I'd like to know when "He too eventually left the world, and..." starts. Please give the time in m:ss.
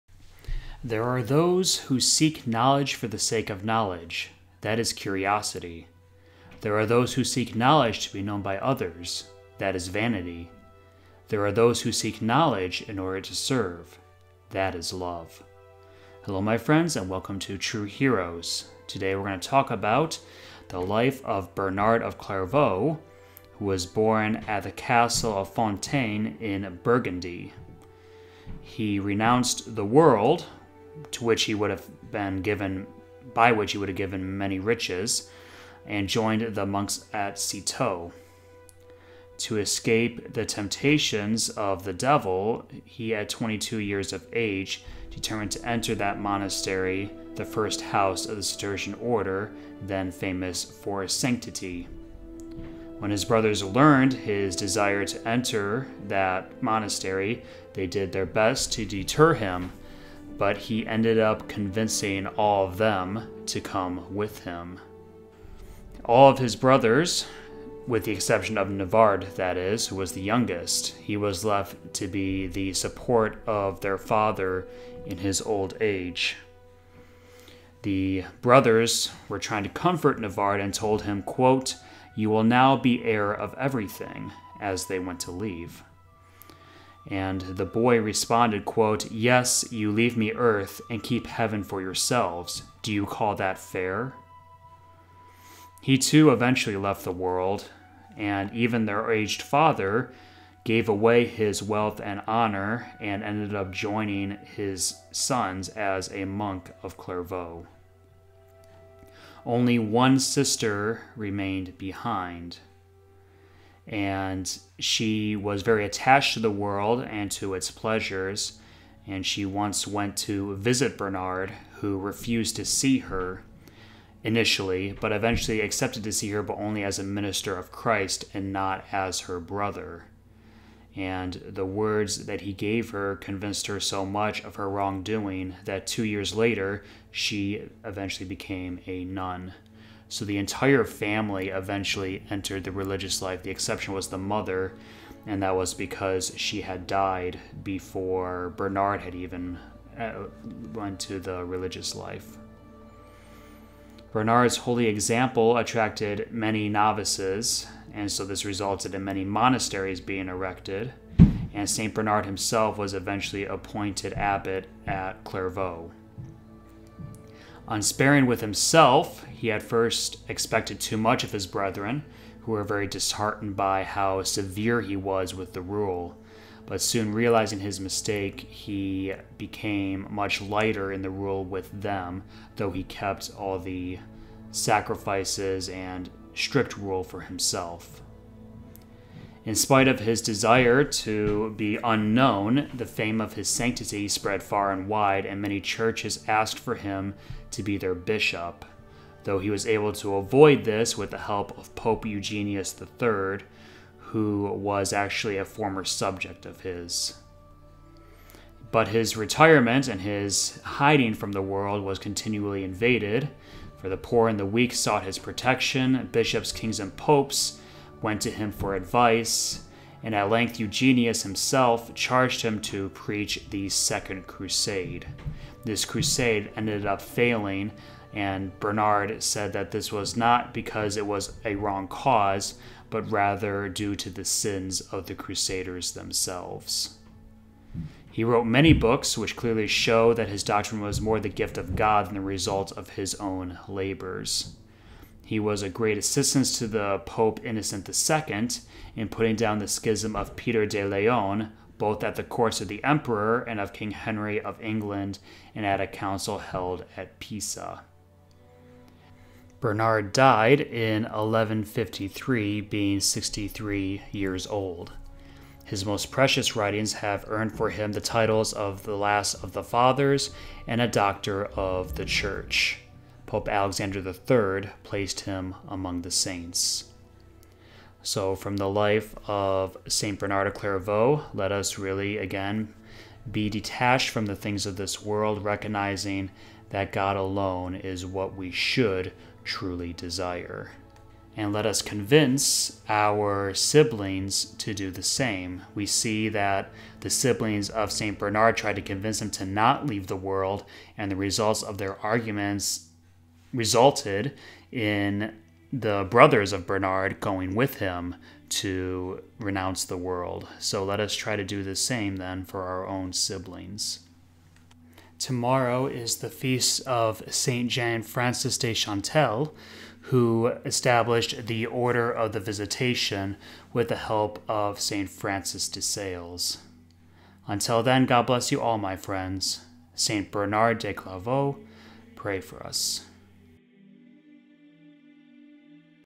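1:35.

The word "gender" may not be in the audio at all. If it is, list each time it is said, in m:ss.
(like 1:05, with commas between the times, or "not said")
not said.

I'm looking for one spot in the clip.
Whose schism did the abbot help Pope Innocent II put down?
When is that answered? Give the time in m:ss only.
4:10.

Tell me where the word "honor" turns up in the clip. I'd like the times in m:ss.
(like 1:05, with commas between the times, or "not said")
1:42.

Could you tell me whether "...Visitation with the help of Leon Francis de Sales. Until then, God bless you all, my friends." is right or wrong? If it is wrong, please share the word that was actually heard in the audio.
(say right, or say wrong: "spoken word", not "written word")
wrong: "Saint", not "Leon".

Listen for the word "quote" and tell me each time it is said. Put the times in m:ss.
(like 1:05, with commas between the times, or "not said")
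1:21, 1:28.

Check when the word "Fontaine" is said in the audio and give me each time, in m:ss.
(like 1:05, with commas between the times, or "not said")
0:25.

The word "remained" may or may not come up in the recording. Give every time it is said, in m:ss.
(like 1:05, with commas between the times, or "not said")
1:51.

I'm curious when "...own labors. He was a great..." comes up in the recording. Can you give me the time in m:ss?
4:03.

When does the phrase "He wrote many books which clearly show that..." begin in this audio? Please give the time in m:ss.
3:58.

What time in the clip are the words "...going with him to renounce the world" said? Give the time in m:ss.
5:07.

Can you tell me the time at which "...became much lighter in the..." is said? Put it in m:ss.
2:59.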